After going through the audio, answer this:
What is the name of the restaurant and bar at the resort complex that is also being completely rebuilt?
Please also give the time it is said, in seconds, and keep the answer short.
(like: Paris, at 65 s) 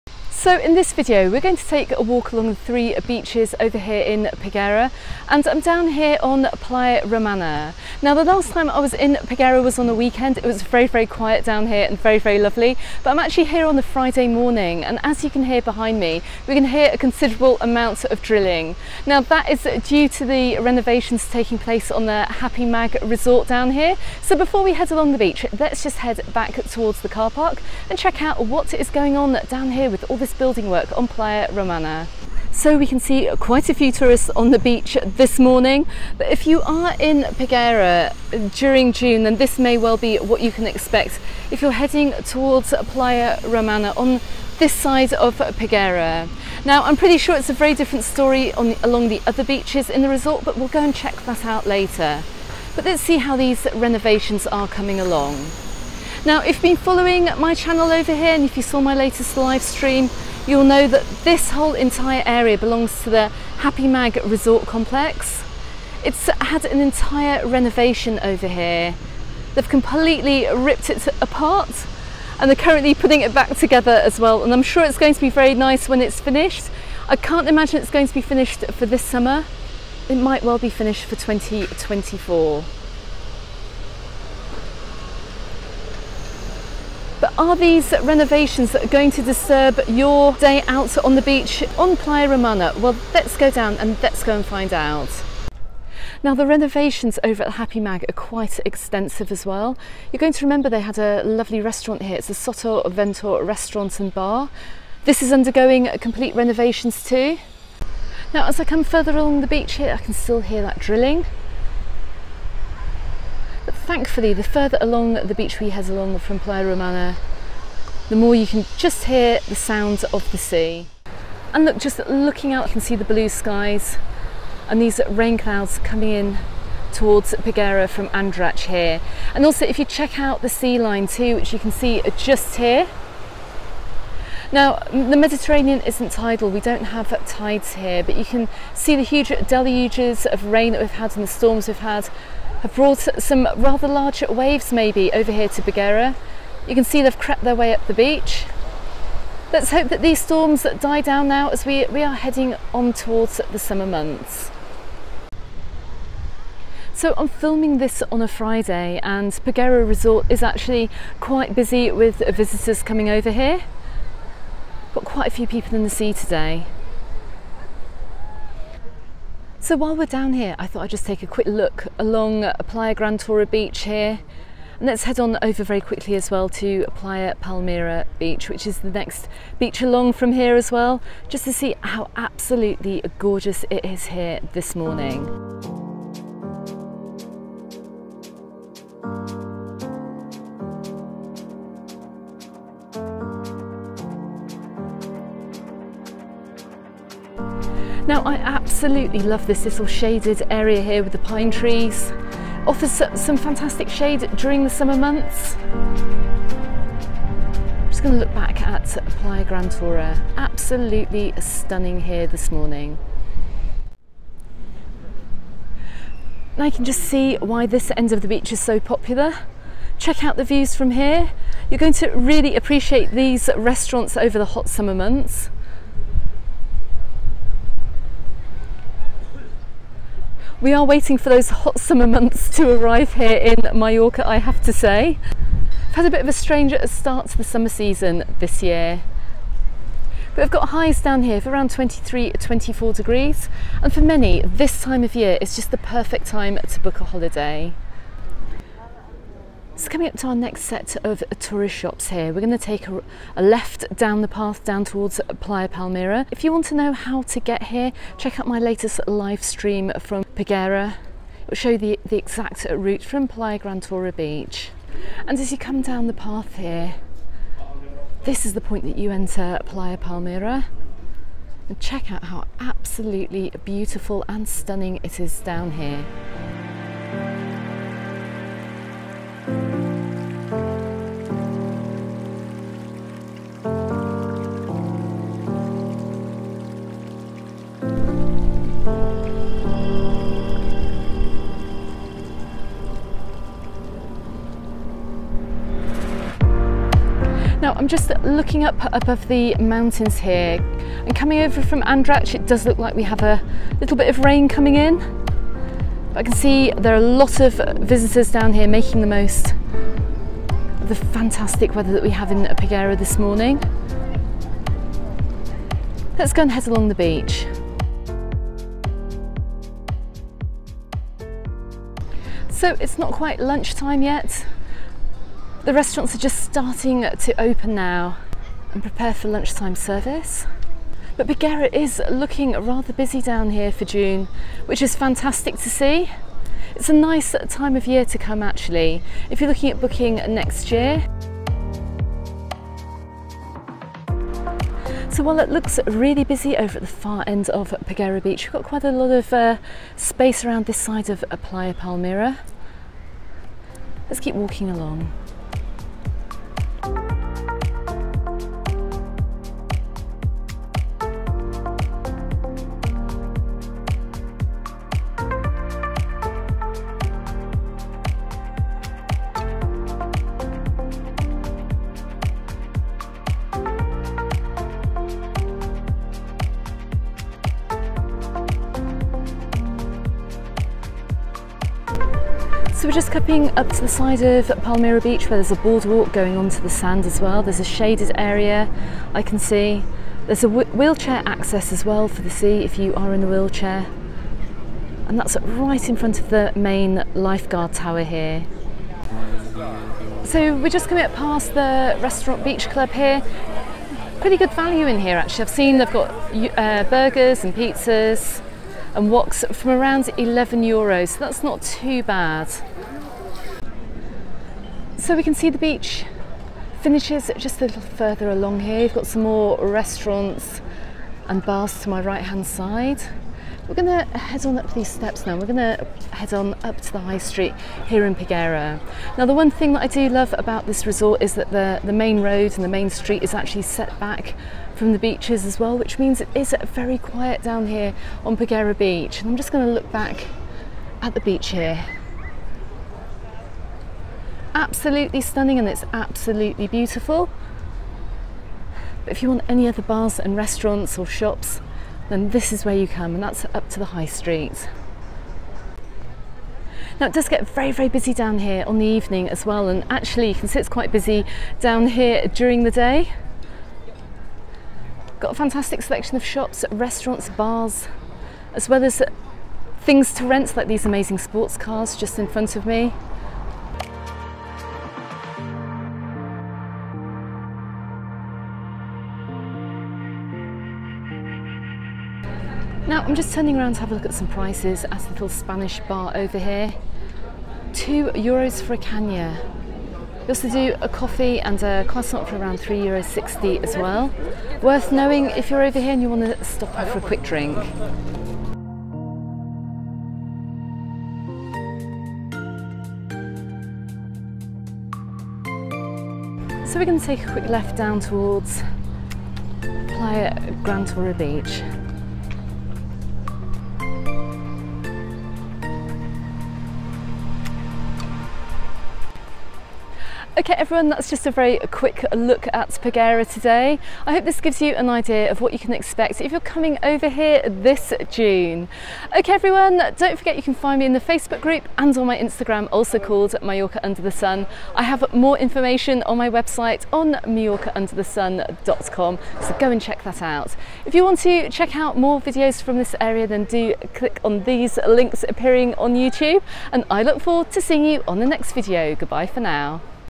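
Soto Ventor, at 102 s.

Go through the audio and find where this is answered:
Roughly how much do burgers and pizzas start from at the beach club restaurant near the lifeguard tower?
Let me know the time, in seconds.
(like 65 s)
410 s.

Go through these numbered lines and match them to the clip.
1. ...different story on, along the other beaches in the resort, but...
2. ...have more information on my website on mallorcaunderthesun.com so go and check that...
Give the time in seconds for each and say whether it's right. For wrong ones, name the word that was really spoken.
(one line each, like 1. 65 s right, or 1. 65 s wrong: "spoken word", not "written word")
1. 47 s right
2. 534 s right.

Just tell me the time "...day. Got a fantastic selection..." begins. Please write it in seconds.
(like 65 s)
462 s.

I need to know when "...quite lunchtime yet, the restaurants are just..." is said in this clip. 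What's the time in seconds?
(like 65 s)
323 s.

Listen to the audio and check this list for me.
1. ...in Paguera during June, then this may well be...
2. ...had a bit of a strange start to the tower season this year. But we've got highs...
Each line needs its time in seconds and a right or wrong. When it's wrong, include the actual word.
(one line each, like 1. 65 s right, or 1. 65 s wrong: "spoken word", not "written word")
1. 36 s right
2. 235 s wrong: "summer", not "tower".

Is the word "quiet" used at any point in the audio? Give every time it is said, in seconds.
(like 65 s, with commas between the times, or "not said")
11 s, 436 s.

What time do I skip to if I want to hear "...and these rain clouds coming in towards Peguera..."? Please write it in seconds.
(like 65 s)
124 s.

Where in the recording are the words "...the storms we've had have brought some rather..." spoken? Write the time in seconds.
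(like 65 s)
141 s.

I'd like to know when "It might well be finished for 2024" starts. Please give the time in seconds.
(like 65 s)
80 s.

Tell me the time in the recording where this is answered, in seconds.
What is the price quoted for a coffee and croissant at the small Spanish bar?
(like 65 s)
492 s.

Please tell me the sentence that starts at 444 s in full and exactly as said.
Absolutely stunning and it's absolutely beautiful.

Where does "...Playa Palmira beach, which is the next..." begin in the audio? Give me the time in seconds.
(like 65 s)
176 s.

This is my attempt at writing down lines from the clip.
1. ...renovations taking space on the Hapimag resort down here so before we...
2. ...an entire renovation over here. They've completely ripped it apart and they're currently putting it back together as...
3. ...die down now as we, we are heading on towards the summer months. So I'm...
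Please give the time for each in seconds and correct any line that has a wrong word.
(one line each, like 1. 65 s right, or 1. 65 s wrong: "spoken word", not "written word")
1. 20 s wrong: "place", not "space"
2. 66 s right
3. 150 s right.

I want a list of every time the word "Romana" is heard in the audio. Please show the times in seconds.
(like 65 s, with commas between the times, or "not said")
7 s, 31 s, 43 s, 92 s, 116 s.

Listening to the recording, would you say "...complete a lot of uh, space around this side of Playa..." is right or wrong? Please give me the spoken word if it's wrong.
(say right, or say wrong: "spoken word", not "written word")
wrong: "quite", not "complete".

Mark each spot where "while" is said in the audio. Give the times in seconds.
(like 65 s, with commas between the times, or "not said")
169 s, 345 s.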